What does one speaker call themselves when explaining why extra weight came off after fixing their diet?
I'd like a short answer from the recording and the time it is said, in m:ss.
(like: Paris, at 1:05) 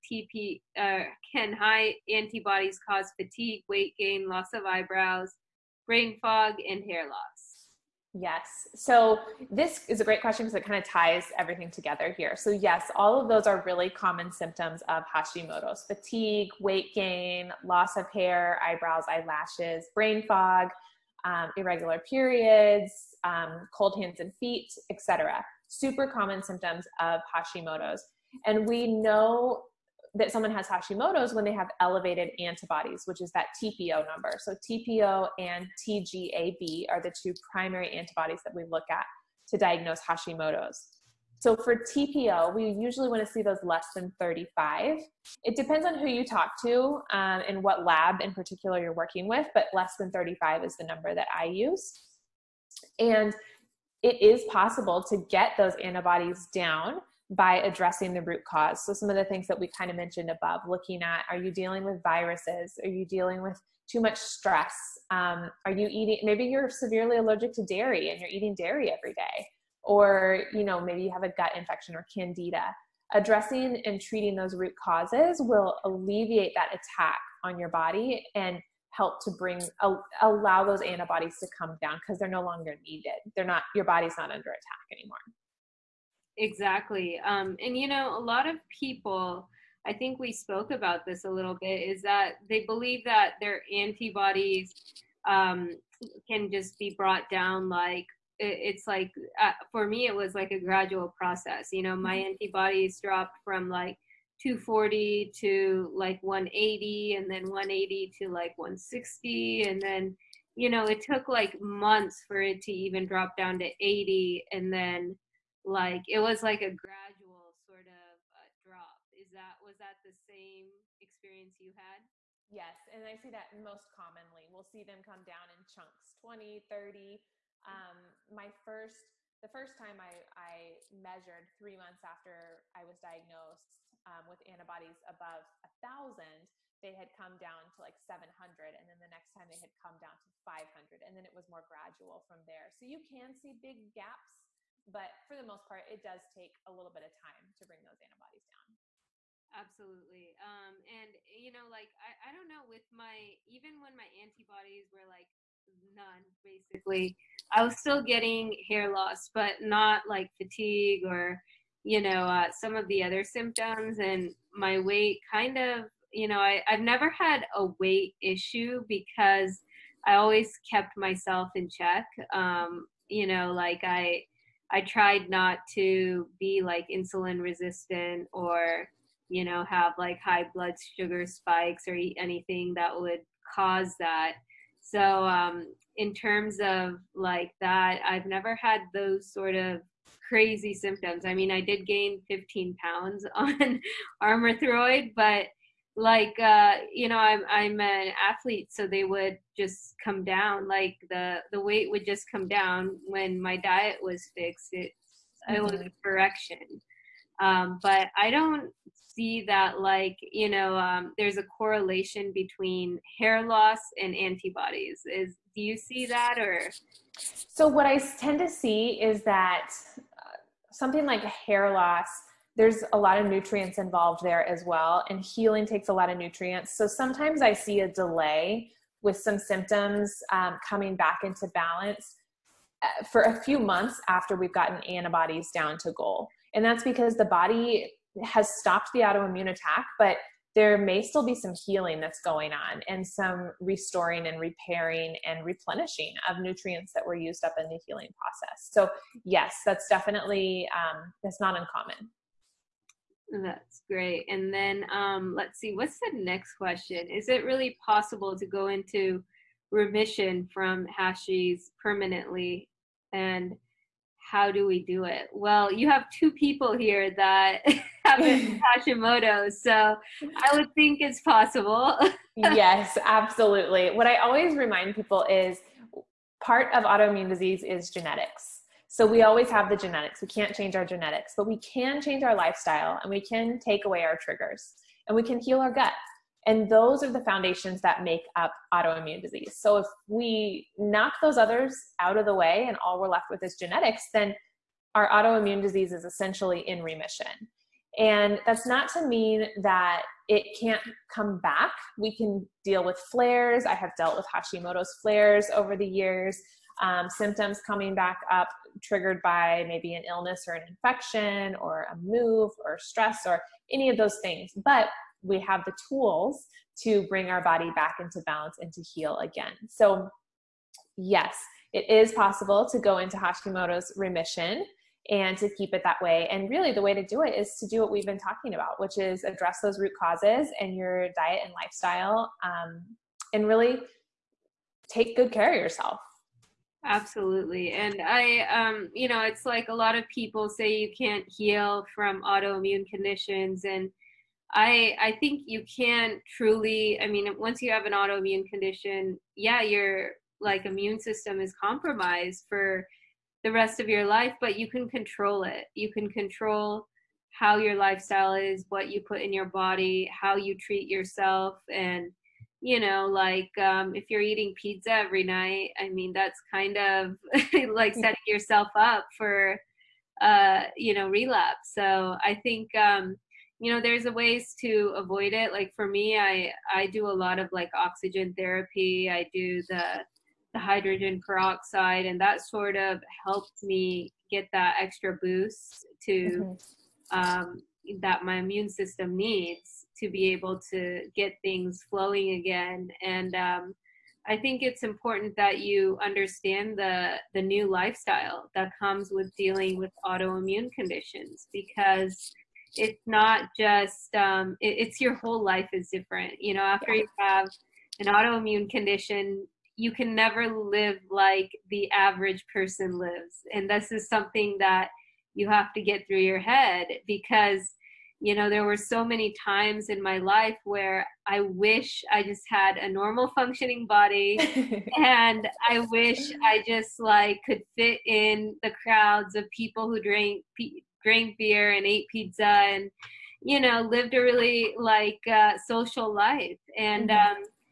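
An athlete, at 3:18.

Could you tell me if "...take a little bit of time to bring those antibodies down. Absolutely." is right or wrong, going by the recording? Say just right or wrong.
right.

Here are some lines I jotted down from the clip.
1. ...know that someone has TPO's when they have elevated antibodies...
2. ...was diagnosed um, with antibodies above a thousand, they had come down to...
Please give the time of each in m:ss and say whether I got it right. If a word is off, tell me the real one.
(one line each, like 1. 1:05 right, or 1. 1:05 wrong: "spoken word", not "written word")
1. 0:28 wrong: "Hashimoto", not "TPO"
2. 2:12 right.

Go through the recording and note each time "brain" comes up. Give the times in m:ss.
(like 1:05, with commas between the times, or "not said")
0:05, 0:19.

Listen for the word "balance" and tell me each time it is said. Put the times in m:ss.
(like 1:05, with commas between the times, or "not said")
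3:51, 5:18.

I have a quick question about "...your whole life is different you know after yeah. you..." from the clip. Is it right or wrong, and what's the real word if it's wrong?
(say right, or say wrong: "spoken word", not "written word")
right.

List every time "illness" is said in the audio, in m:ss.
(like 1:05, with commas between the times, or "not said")
5:10.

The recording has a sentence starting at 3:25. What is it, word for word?
it was a correction um, but I don't see that like you know um, there's a correlation between hair loss and antibodies.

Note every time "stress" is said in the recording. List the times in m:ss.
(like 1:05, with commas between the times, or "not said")
1:04, 5:12.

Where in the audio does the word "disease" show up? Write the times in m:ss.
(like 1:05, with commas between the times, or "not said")
4:37, 4:49, 4:55.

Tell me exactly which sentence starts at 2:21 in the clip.
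And then it was more gradual from there.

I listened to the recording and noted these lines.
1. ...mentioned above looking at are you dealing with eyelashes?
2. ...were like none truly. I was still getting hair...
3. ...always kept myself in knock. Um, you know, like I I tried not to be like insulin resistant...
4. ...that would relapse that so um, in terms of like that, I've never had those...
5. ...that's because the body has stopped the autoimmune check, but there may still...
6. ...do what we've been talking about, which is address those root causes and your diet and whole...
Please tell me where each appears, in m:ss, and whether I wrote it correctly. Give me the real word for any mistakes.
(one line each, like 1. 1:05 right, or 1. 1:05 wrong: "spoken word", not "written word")
1. 0:59 wrong: "viruses", not "eyelashes"
2. 2:34 wrong: "basically", not "truly"
3. 2:50 wrong: "check", not "knock"
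4. 3:02 wrong: "cause", not "relapse"
5. 3:56 wrong: "attack", not "check"
6. 5:27 wrong: "lifestyle", not "whole".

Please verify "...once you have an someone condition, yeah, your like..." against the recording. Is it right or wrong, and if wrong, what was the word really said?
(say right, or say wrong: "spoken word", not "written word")
wrong: "autoimmune", not "someone".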